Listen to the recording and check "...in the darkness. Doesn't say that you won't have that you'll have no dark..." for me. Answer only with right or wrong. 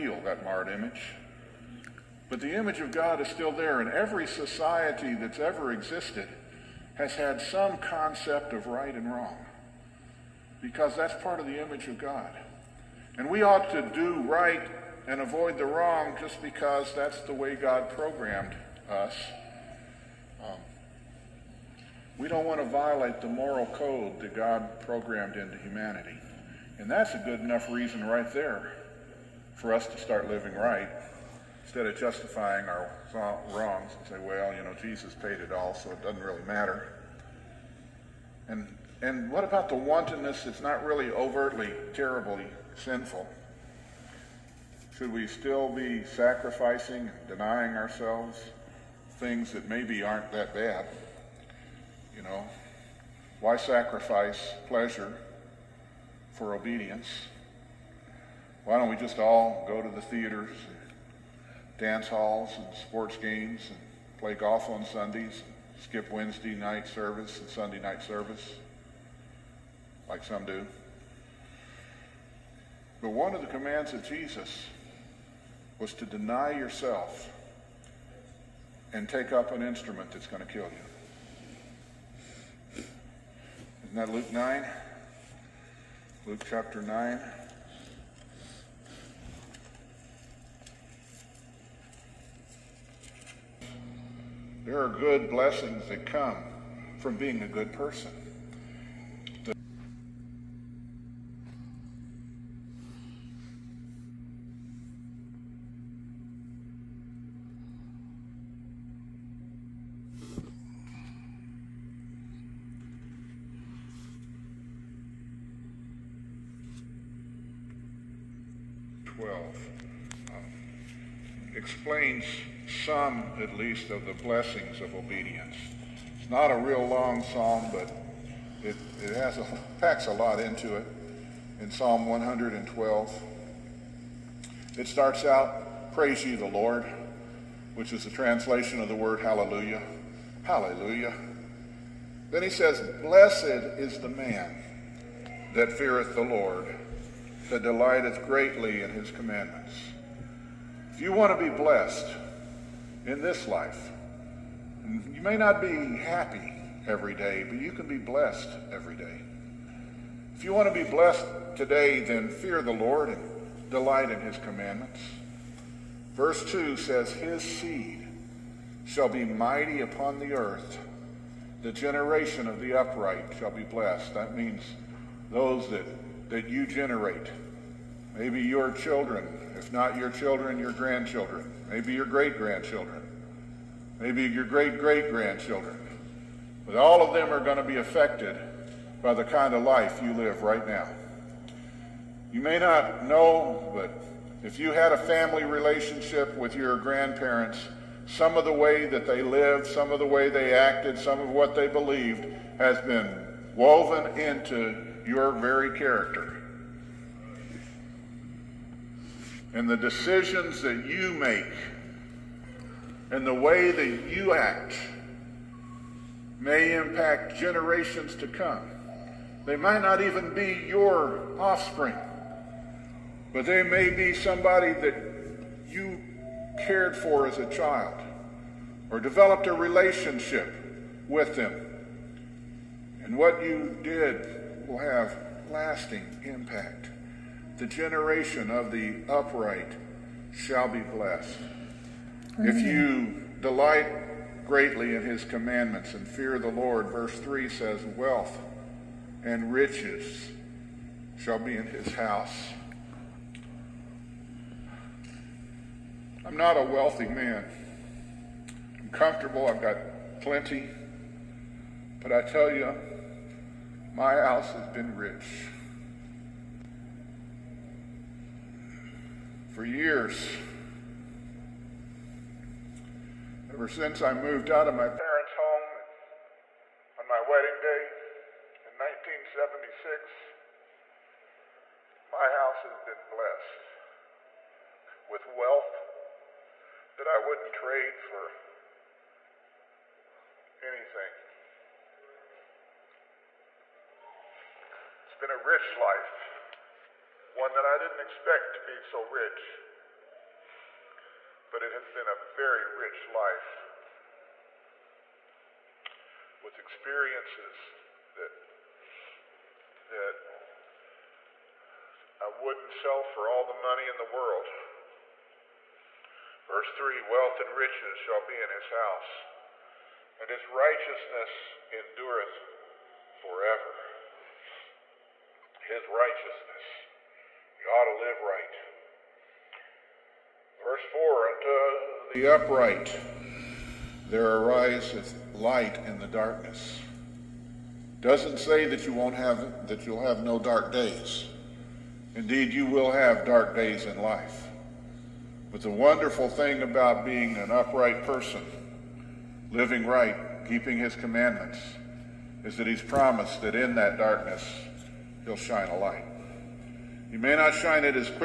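right.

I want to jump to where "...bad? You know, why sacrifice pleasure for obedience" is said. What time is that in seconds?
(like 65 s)
50 s.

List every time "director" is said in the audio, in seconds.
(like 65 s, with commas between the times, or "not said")
not said.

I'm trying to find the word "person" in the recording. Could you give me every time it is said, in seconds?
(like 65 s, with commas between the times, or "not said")
97 s, 348 s.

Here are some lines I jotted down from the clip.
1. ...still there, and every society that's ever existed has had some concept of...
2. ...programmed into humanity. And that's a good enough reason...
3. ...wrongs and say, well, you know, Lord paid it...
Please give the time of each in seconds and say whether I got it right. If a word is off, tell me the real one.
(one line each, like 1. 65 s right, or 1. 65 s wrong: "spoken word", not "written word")
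1. 3 s right
2. 24 s right
3. 33 s wrong: "Jesus", not "Lord".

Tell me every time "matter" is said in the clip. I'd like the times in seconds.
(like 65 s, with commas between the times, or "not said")
36 s.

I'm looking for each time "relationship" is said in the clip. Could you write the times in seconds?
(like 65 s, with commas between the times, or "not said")
195 s, 229 s.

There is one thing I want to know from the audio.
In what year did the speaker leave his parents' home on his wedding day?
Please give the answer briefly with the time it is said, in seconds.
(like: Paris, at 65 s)
1976, at 278 s.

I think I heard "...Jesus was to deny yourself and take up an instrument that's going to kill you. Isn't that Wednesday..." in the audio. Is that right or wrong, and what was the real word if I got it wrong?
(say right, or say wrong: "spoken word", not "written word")
wrong: "Luke", not "Wednesday".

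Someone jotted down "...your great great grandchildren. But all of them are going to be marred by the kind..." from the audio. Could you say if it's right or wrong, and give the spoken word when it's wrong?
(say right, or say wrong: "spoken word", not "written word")
wrong: "affected", not "marred".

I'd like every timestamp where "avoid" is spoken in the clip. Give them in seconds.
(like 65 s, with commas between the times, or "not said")
15 s.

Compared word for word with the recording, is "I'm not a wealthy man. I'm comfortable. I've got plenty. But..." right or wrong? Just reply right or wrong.
right.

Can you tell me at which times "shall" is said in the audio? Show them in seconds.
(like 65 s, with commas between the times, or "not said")
168 s, 173 s, 240 s, 251 s, 317 s.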